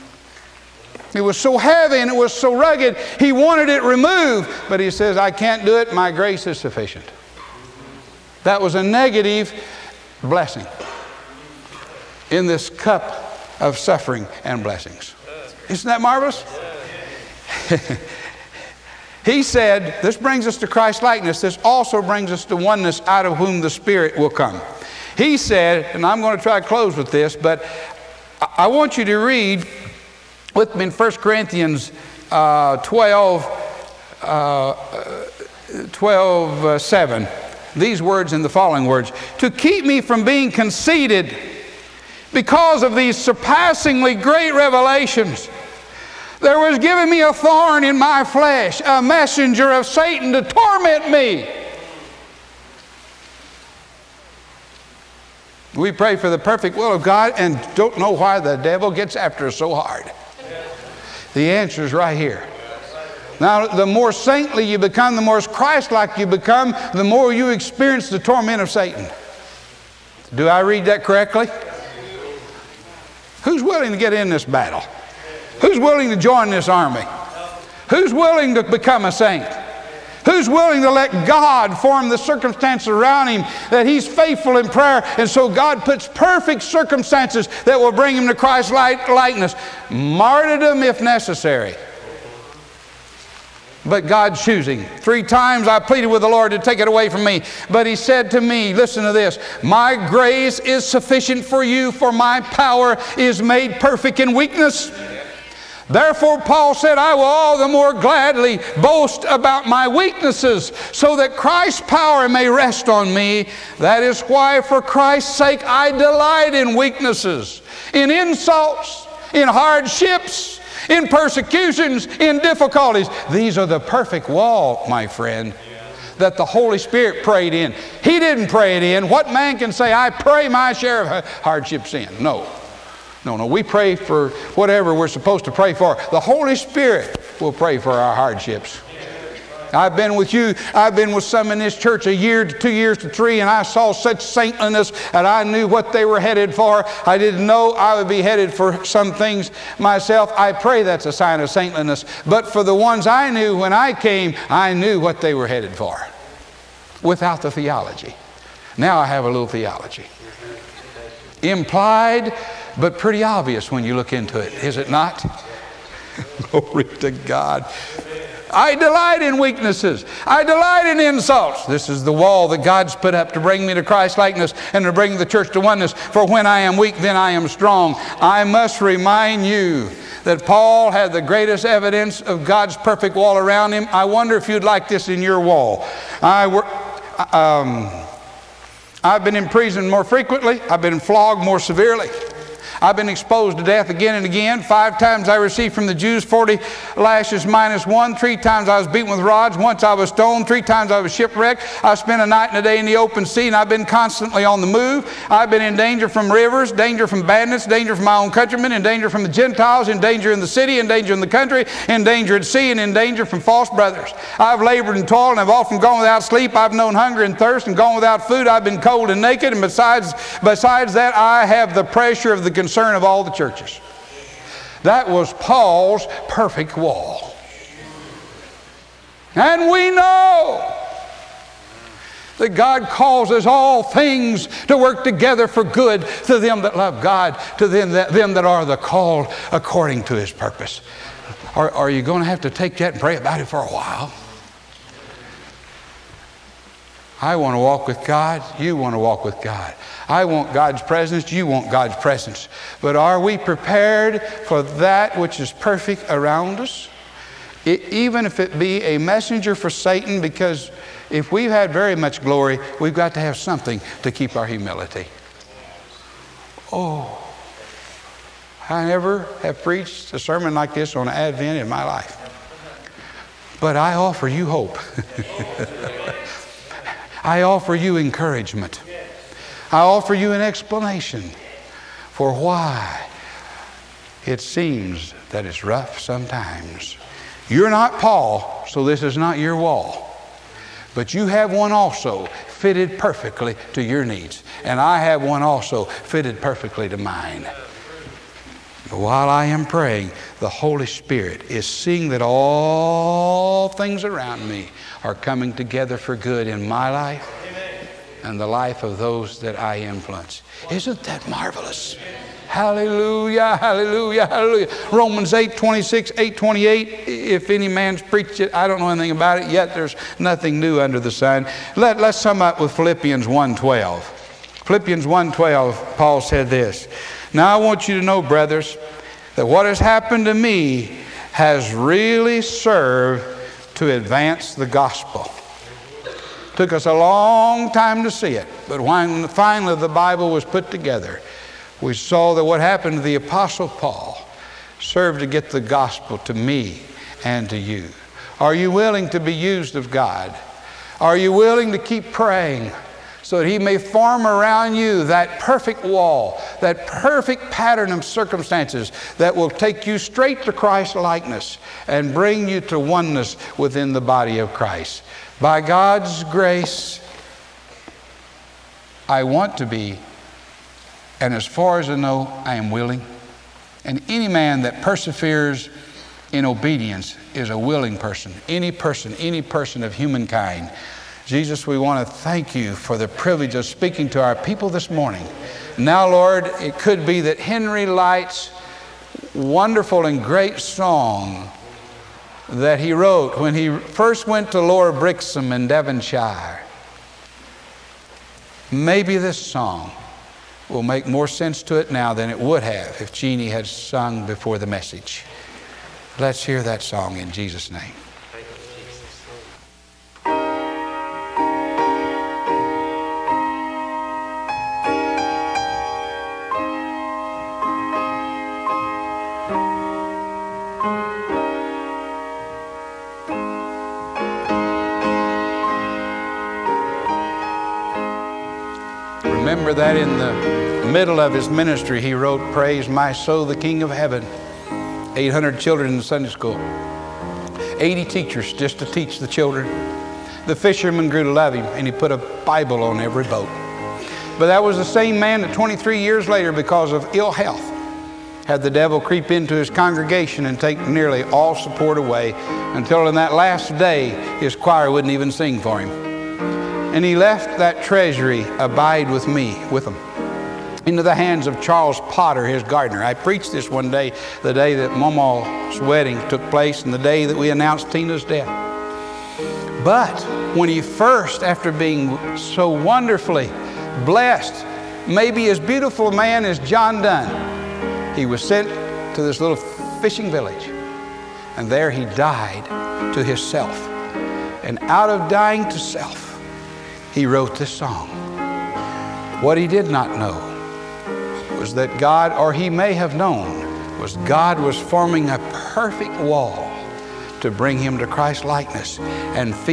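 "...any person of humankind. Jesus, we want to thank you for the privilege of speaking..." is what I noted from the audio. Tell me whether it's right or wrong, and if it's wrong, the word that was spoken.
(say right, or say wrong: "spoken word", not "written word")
right.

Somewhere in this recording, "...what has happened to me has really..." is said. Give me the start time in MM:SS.
05:29.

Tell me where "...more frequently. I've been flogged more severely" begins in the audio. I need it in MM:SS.
03:09.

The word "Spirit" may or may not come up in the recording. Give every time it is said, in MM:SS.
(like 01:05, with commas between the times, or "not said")
00:23, 02:06, 02:16, 05:00.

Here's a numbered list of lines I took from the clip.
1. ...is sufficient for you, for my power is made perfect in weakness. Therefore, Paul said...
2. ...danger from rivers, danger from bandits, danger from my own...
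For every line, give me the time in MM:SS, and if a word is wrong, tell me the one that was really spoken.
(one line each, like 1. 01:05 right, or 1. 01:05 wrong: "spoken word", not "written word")
1. 01:40 right
2. 03:25 right.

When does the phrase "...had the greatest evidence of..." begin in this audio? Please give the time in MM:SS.
03:00.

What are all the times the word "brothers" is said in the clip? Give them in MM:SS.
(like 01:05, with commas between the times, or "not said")
03:33, 05:28.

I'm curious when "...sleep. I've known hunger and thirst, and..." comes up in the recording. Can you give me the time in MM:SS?
03:36.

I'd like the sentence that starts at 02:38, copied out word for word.
Now I have a little theology.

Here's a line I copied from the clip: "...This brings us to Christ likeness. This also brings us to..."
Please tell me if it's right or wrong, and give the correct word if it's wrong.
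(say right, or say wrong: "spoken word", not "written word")
right.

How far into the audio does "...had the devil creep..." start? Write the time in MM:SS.
07:28.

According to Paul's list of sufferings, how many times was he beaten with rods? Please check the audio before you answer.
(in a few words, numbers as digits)
3.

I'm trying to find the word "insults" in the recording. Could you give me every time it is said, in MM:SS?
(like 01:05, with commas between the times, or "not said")
01:58, 02:50.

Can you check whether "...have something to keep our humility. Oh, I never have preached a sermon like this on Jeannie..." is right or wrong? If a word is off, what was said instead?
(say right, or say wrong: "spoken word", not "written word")
wrong: "Advent", not "Jeannie".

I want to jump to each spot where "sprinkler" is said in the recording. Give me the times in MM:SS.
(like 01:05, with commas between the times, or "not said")
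not said.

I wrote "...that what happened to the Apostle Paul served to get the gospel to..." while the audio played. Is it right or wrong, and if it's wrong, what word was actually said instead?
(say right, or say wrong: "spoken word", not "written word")
right.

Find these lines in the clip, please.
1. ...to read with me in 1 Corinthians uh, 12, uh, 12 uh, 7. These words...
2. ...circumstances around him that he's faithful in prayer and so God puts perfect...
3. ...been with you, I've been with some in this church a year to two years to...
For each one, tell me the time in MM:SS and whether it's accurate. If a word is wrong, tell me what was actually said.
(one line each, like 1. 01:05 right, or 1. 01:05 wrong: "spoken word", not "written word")
1. 00:29 right
2. 01:22 right
3. 02:19 right.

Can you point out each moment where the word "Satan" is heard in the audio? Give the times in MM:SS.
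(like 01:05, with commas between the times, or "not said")
00:49, 01:08, 04:19.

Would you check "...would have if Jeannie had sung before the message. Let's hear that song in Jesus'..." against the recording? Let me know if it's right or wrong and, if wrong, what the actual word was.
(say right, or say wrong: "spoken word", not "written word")
right.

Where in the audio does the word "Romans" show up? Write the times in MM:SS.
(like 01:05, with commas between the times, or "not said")
05:14.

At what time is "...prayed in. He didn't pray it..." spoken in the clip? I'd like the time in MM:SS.
02:07.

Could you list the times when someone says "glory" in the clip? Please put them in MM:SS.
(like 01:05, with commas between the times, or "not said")
02:46, 04:22.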